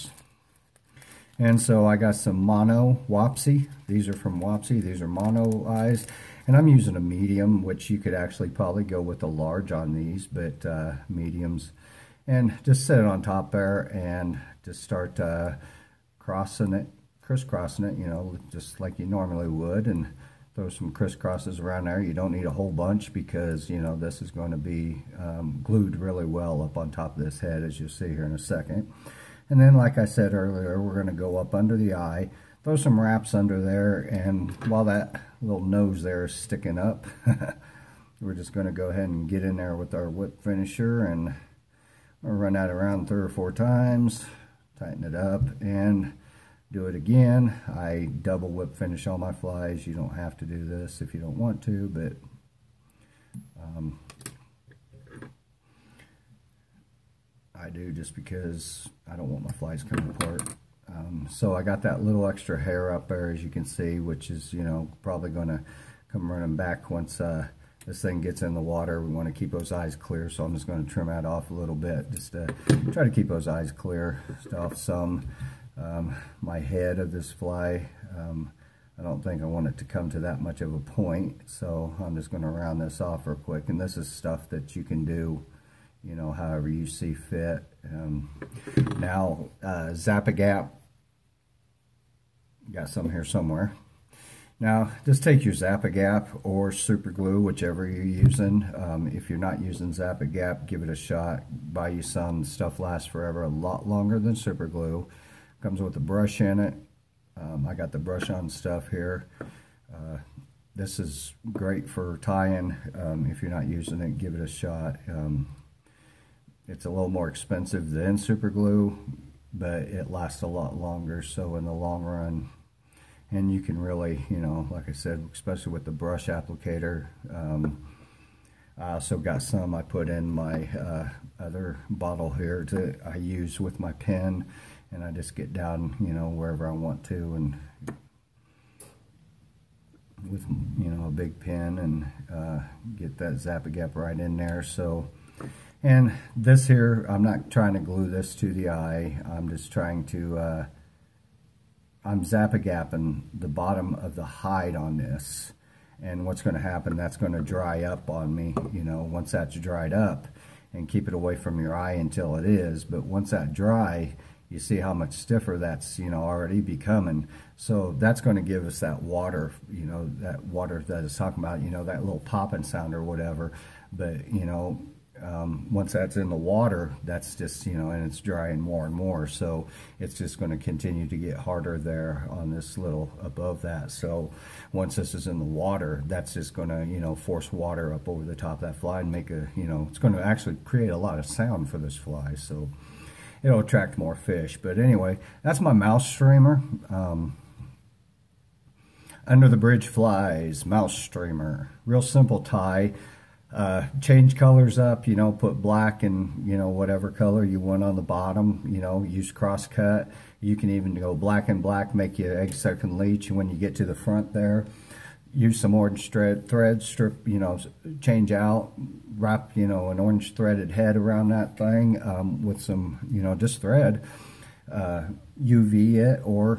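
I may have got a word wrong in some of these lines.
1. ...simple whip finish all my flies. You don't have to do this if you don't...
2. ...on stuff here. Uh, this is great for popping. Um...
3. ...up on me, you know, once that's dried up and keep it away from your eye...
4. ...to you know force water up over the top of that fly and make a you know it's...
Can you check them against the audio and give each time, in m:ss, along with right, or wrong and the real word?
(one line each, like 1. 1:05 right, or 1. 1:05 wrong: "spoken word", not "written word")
1. 0:48 wrong: "double", not "simple"
2. 1:48 wrong: "tying", not "popping"
3. 2:37 right
4. 3:06 right.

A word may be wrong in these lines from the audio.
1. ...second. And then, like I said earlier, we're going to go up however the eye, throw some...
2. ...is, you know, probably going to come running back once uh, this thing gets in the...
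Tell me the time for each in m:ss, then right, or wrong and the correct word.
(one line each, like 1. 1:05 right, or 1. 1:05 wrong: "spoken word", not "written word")
1. 0:28 wrong: "under", not "however"
2. 1:04 right.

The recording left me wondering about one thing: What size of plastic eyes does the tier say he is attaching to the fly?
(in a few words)
Medium.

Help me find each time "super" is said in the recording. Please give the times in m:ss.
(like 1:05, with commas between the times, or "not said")
1:36, 1:44, 1:58.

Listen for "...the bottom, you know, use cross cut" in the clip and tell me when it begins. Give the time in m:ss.
3:27.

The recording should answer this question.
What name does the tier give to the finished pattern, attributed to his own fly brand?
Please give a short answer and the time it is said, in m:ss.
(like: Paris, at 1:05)
Under the Bridge Flies mouse streamer, at 3:19.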